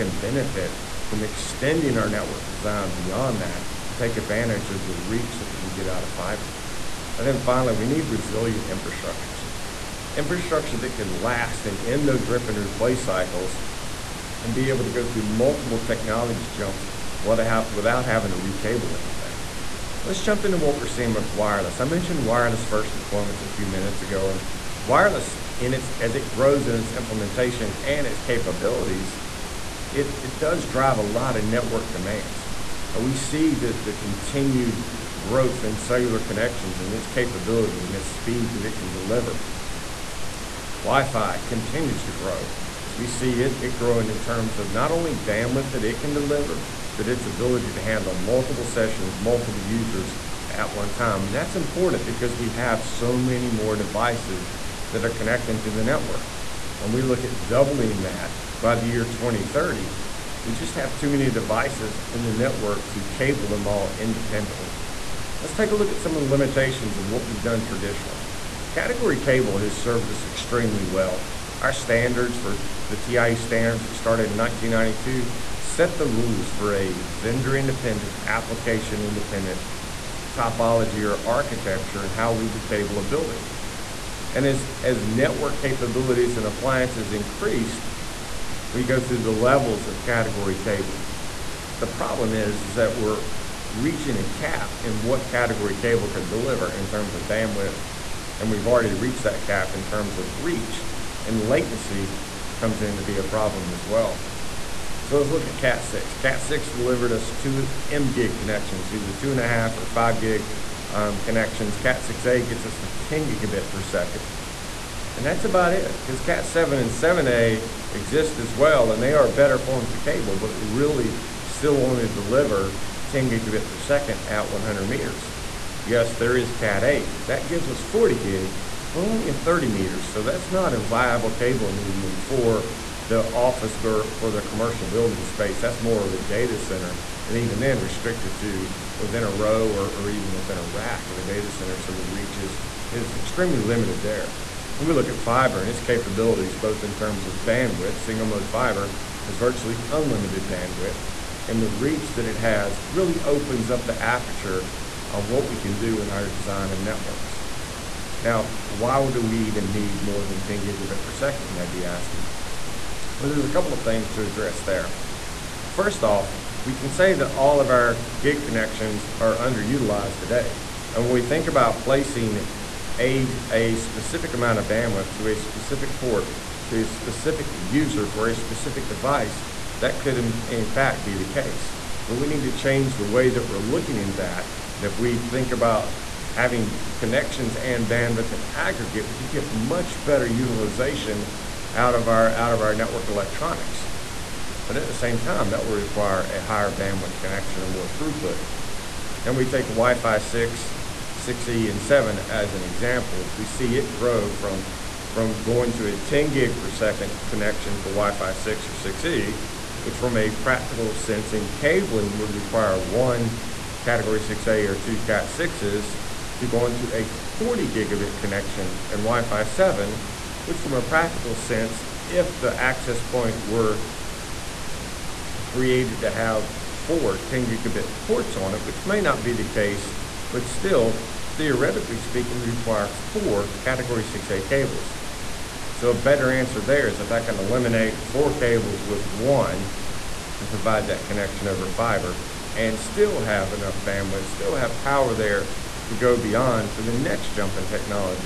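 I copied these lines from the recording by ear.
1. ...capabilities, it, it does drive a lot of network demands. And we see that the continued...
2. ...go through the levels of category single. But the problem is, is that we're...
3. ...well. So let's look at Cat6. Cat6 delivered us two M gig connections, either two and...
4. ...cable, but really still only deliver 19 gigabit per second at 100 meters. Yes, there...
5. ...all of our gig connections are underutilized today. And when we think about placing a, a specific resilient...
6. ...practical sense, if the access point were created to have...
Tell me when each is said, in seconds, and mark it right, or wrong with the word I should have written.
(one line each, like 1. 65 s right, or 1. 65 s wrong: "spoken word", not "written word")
1. 28 s right
2. 88 s wrong: "cable", not "single"
3. 103 s right
4. 119 s wrong: "10", not "19"
5. 167 s wrong: "amount", not "resilient"
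6. 220 s right.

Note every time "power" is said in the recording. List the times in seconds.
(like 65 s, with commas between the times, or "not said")
244 s.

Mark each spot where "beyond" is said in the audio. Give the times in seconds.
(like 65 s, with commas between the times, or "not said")
2 s, 246 s.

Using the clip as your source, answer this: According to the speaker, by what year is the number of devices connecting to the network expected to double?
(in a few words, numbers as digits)
2030.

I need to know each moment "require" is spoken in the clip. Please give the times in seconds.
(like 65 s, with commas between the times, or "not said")
195 s, 212 s, 232 s.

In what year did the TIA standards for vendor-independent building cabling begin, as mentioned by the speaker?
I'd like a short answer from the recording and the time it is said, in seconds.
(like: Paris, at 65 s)
1992, at 74 s.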